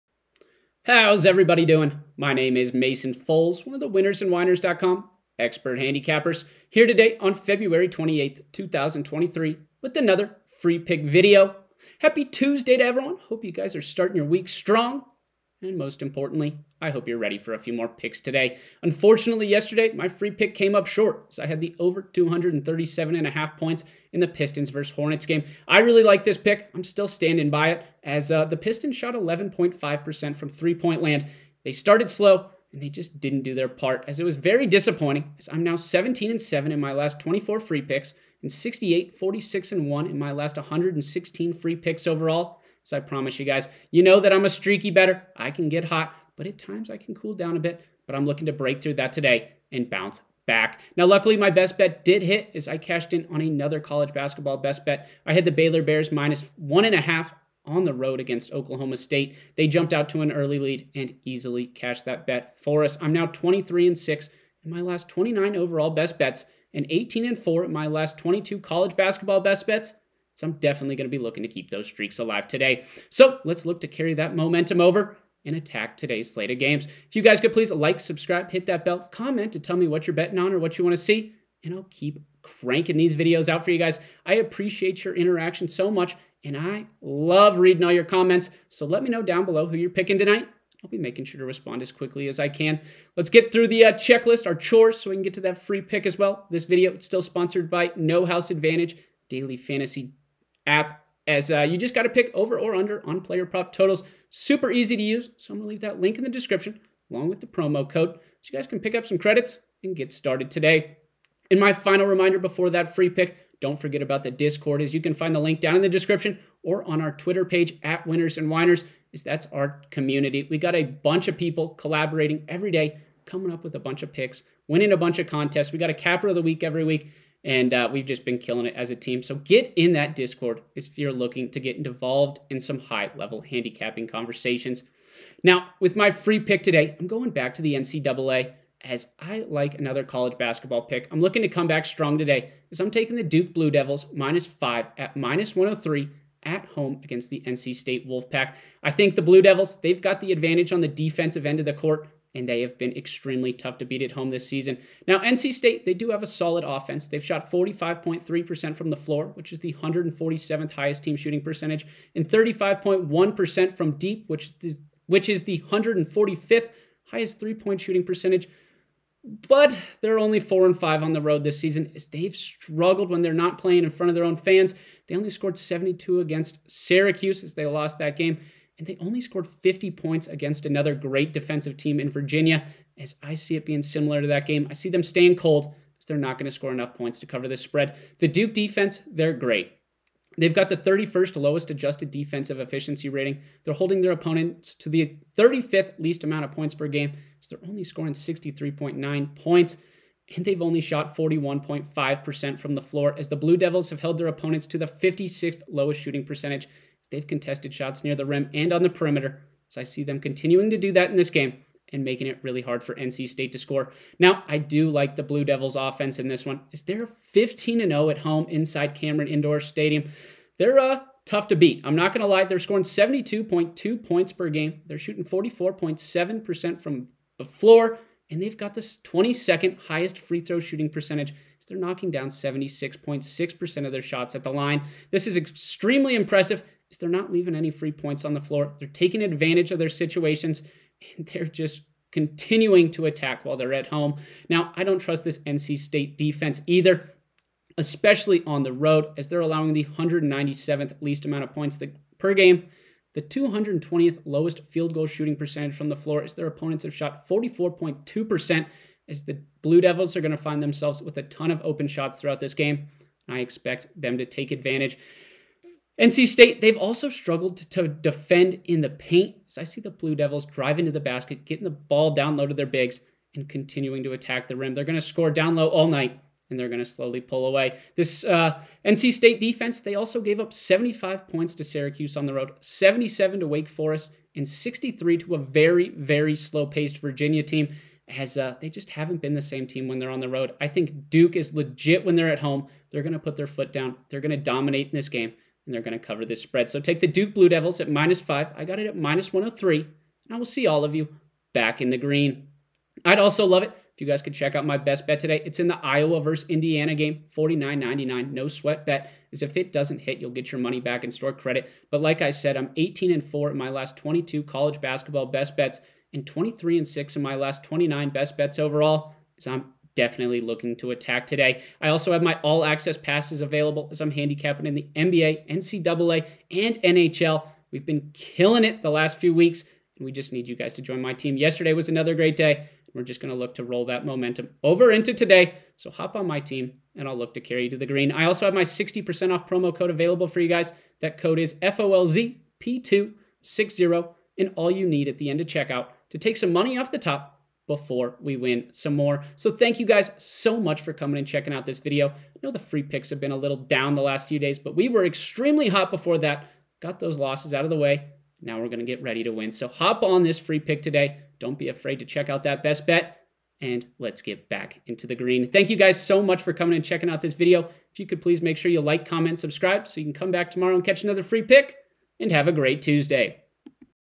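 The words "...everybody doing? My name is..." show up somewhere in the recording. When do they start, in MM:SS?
00:01.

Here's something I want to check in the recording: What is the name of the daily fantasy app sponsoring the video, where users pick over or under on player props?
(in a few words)
No House Advantage.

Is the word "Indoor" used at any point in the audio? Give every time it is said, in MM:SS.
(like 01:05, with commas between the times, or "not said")
03:39.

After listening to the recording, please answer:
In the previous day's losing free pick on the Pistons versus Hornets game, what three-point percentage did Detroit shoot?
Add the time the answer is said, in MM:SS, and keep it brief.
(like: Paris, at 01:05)
11.5%, at 00:29.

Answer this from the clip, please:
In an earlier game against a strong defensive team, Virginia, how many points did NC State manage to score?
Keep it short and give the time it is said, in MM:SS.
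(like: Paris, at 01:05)
50, at 02:59.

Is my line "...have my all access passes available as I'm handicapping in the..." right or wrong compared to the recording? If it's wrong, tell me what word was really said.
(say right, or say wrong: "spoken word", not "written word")
right.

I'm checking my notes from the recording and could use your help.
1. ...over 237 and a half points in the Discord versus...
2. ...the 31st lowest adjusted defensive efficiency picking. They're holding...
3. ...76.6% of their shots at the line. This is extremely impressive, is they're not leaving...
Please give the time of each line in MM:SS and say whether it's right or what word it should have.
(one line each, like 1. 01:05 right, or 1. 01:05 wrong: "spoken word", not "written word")
1. 00:21 wrong: "Pistons", not "Discord"
2. 03:10 wrong: "rating", not "picking"
3. 03:52 right.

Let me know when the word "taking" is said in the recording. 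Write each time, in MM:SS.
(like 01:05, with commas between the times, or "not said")
02:22, 03:58.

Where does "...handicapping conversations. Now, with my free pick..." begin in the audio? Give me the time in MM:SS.
02:13.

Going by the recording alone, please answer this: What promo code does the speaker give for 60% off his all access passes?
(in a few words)
FOLZP260.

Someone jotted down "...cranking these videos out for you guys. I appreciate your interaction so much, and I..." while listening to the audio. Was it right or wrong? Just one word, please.
right.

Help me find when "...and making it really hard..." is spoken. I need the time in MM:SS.
03:31.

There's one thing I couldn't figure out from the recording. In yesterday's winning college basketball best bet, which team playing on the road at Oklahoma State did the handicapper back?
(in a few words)
Baylor Bears.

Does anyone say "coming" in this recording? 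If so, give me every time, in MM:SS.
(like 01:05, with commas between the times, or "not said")
02:03, 05:50, 06:06.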